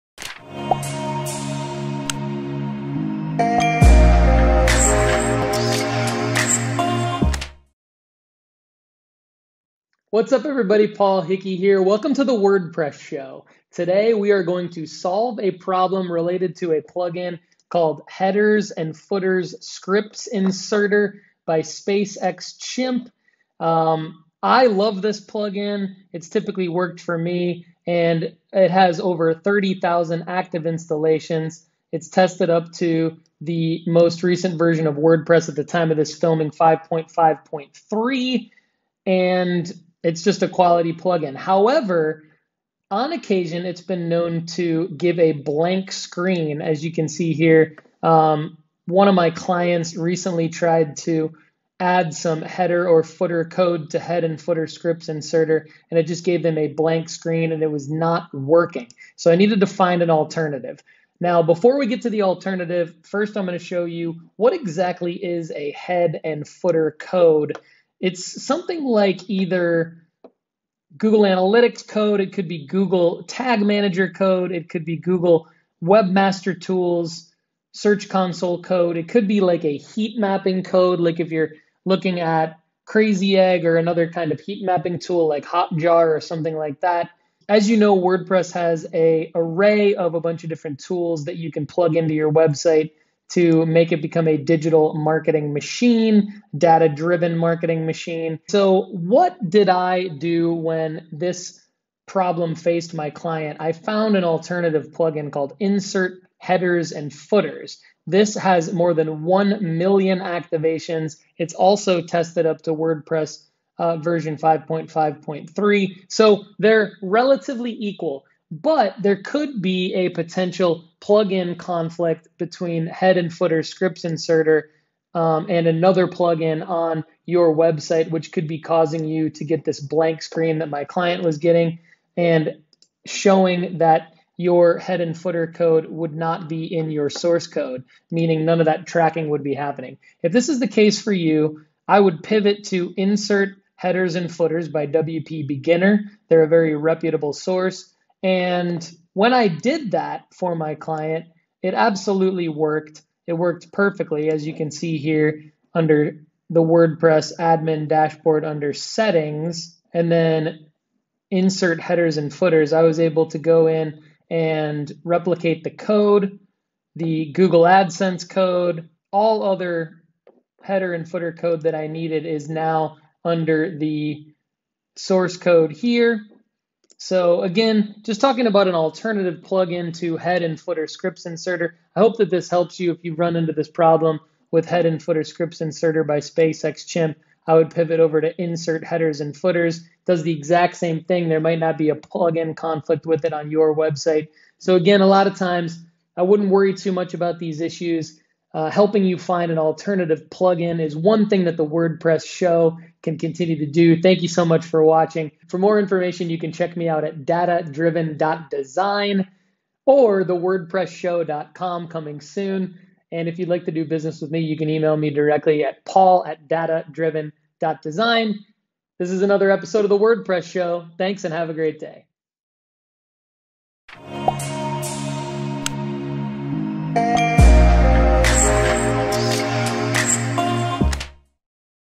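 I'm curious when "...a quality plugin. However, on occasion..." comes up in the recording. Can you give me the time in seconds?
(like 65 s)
40 s.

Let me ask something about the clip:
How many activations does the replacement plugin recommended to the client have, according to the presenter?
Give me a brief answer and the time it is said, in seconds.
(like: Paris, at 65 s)
More than 1 million, at 108 s.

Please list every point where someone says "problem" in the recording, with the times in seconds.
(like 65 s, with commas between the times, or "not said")
15 s, 102 s, 183 s.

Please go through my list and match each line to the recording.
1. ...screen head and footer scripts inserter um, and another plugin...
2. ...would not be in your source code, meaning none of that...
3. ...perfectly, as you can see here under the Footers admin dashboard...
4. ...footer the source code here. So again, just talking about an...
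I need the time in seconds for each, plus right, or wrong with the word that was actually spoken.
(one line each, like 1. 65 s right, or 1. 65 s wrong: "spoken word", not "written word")
1. 122 s wrong: "between", not "screen"
2. 135 s right
3. 153 s wrong: "WordPress", not "Footers"
4. 173 s wrong: "under", not "footer".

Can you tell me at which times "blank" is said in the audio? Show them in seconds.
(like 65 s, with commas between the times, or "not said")
45 s, 56 s, 129 s.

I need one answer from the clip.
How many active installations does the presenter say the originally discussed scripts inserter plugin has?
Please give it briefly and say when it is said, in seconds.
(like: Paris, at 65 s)
Over 30,000, at 28 s.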